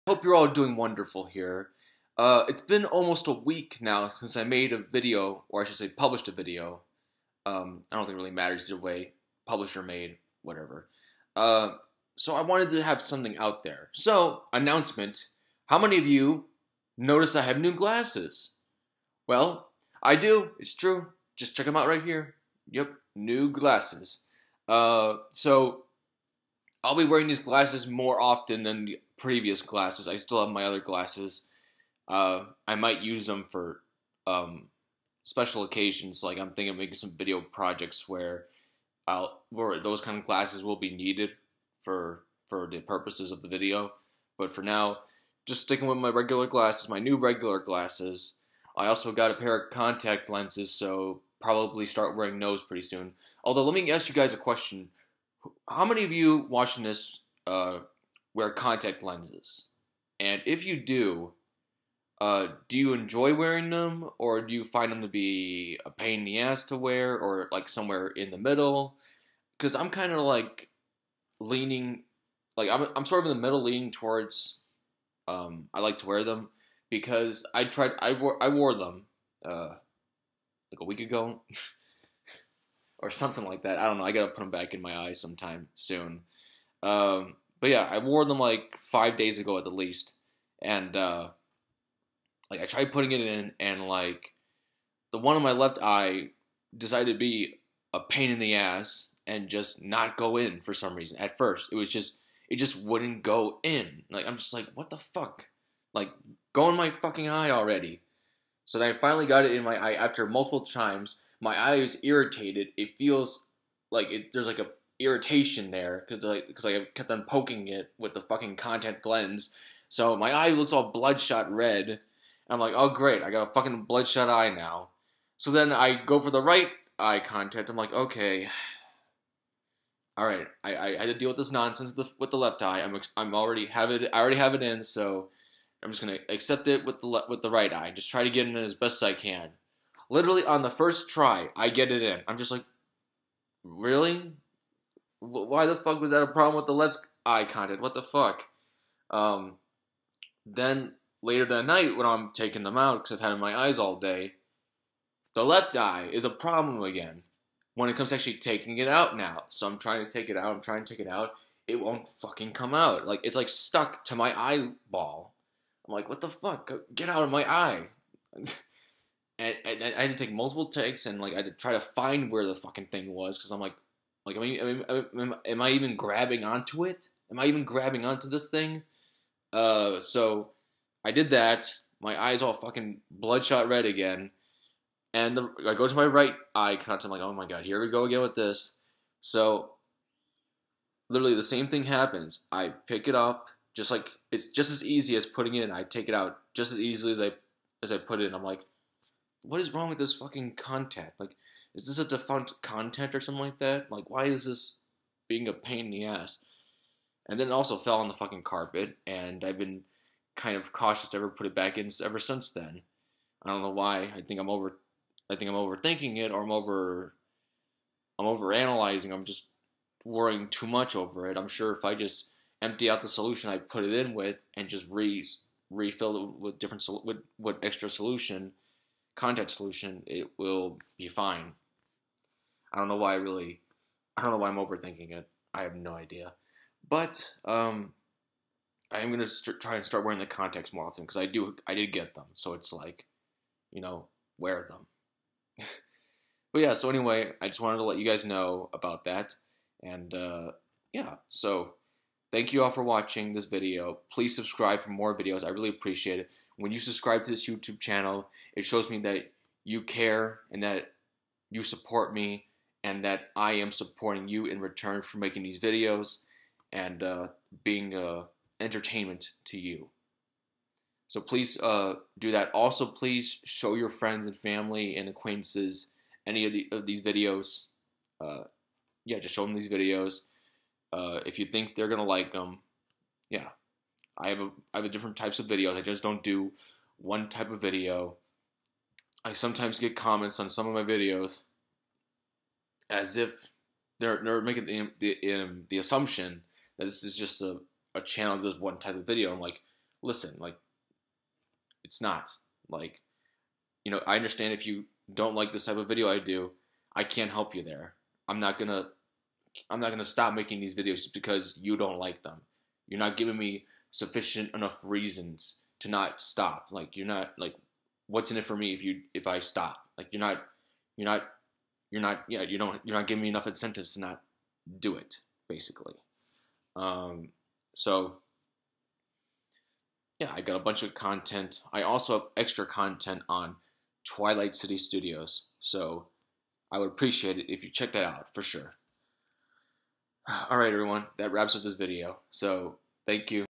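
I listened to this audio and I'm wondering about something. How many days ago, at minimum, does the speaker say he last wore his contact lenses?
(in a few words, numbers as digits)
5.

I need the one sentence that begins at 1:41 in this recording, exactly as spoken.
At first, it was just it just wouldn't go in.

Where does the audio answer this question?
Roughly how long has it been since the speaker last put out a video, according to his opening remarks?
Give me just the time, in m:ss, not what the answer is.
0:02.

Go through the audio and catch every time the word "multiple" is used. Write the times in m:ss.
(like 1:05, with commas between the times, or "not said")
1:50, 2:50.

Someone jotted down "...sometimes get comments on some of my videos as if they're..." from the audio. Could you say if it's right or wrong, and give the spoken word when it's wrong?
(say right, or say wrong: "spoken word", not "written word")
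right.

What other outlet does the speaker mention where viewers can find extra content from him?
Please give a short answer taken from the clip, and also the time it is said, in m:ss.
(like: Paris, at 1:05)
Twilight City Studios, at 5:34.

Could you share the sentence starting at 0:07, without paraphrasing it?
Um, I don't think it really matters either way, published or made, whatever.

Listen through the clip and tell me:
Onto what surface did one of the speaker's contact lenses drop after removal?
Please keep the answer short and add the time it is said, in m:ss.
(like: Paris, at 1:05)
carpet, at 3:28.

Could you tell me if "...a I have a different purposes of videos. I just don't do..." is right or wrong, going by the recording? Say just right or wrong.
wrong.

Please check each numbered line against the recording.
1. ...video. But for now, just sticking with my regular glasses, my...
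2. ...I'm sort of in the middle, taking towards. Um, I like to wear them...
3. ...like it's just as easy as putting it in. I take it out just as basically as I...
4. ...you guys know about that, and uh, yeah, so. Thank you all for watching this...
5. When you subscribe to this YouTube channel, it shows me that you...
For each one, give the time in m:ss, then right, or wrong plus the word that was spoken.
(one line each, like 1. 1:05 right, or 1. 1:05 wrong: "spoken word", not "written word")
1. 0:43 right
2. 1:12 wrong: "leaning", not "taking"
3. 3:13 wrong: "easily", not "basically"
4. 4:07 right
5. 4:16 right.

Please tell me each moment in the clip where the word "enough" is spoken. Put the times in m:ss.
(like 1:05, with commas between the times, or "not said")
5:14, 5:23.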